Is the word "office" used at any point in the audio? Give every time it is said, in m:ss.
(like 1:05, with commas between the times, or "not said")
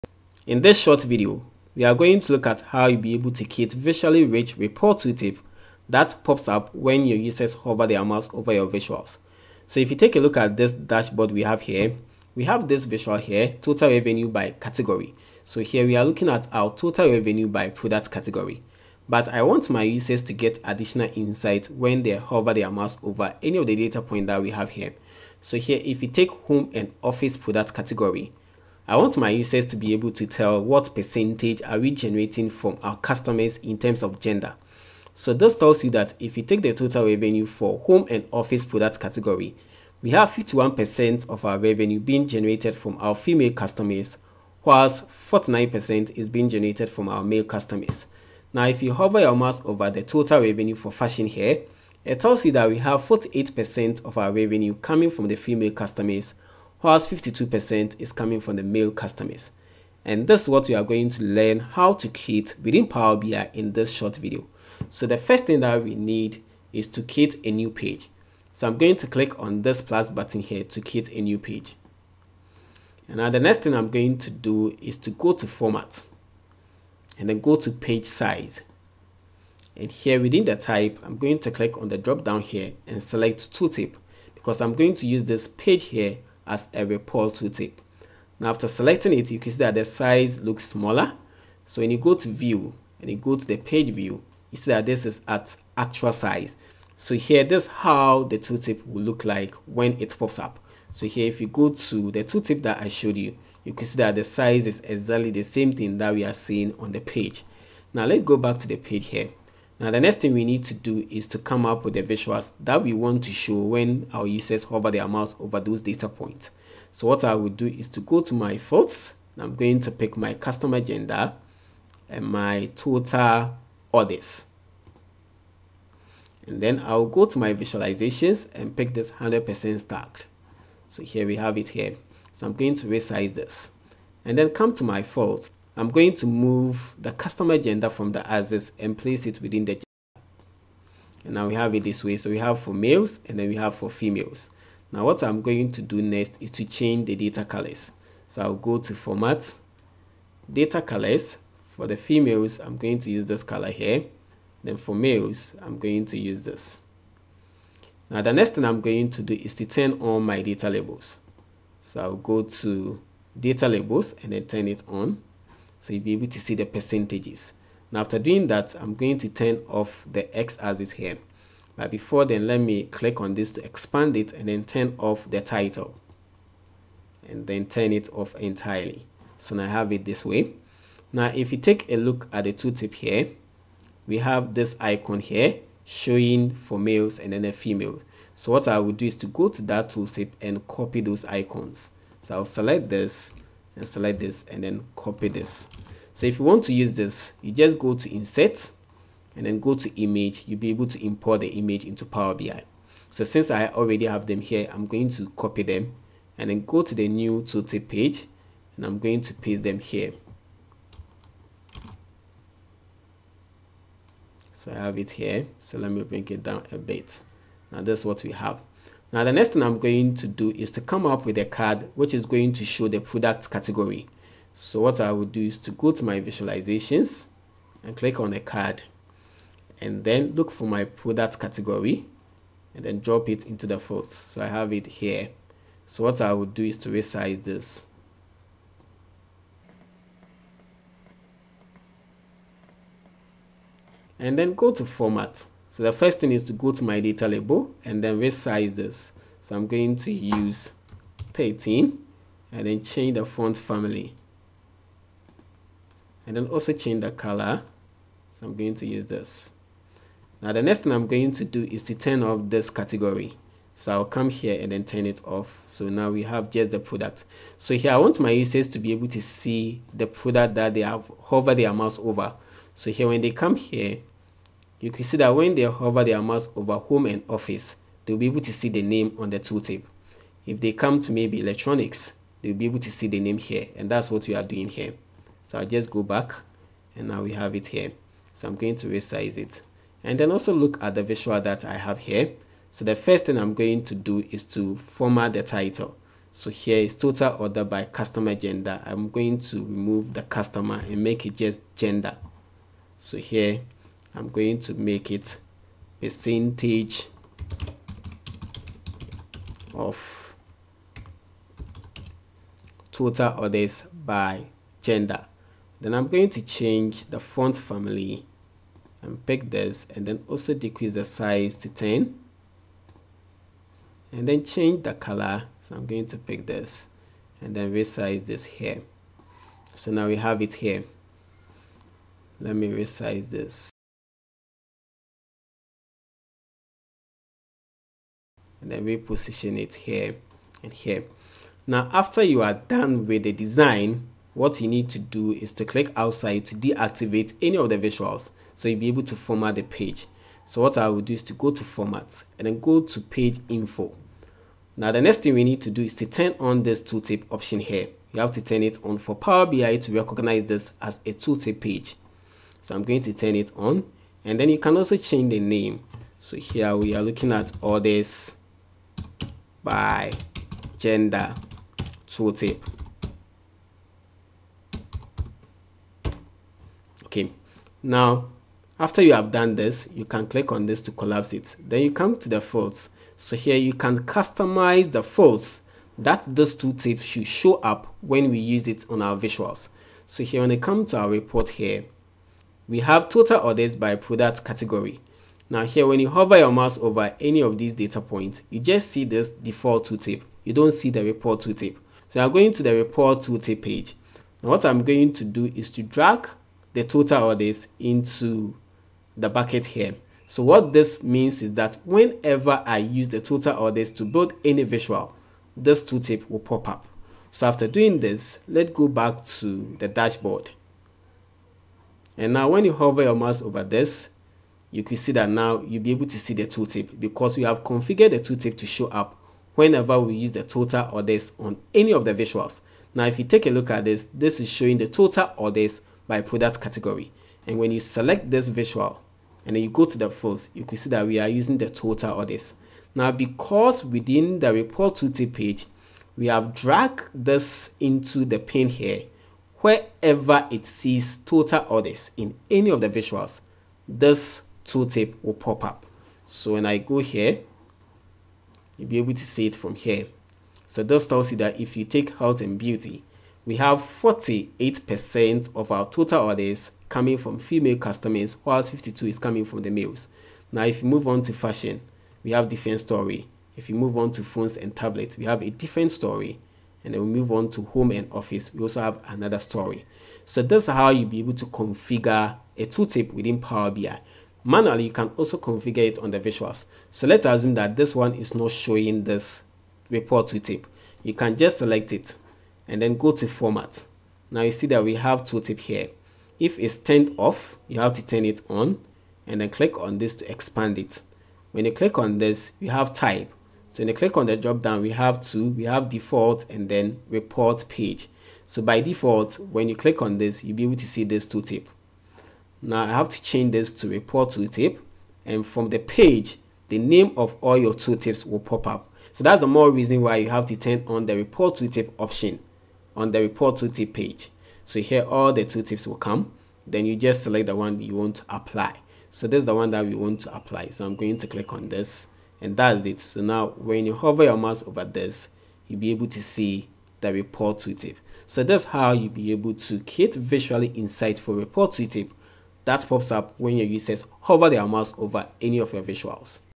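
0:27, 0:38, 4:37, 7:58.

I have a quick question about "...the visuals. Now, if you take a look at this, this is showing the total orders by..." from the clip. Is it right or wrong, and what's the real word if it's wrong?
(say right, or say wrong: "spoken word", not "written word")
right.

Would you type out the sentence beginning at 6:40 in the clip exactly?
You don't see the report tooltip.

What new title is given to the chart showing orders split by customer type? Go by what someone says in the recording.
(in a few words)
Percentage of total orders by gender.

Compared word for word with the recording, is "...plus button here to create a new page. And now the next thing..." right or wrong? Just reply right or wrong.
right.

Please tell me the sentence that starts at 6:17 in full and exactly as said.
Okay, now after you have done this, you can click on this to collapse it.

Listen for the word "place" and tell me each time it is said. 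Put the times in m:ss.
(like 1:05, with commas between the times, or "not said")
2:18.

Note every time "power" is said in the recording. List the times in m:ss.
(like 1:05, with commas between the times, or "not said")
1:02, 3:22, 5:59, 8:03.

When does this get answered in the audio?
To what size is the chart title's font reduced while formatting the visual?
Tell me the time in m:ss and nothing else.
5:21.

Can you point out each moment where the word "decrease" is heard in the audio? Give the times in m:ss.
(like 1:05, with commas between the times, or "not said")
5:20.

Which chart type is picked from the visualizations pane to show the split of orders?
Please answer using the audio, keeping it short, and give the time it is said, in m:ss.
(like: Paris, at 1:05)
100% stacked, at 2:09.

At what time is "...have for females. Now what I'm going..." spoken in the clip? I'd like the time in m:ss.
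2:23.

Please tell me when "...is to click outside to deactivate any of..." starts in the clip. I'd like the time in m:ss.
5:45.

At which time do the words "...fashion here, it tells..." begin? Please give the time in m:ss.
0:50.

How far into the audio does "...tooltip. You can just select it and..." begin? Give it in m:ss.
8:10.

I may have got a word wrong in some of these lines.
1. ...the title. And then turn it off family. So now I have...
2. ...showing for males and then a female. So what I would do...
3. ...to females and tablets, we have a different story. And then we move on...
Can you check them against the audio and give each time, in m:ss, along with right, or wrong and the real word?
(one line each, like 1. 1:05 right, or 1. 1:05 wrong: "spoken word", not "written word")
1. 2:55 wrong: "entirely", not "family"
2. 3:05 right
3. 7:54 wrong: "phones", not "females".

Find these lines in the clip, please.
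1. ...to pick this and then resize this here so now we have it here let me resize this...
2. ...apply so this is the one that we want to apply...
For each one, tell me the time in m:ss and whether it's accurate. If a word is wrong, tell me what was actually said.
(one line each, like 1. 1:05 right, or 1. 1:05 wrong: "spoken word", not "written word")
1. 5:26 right
2. 8:48 right.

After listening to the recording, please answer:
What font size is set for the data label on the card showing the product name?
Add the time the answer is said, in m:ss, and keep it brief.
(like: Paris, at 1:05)
13, at 4:11.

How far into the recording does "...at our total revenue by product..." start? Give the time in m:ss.
0:16.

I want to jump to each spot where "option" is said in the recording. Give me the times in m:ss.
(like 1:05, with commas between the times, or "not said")
5:57, 8:41.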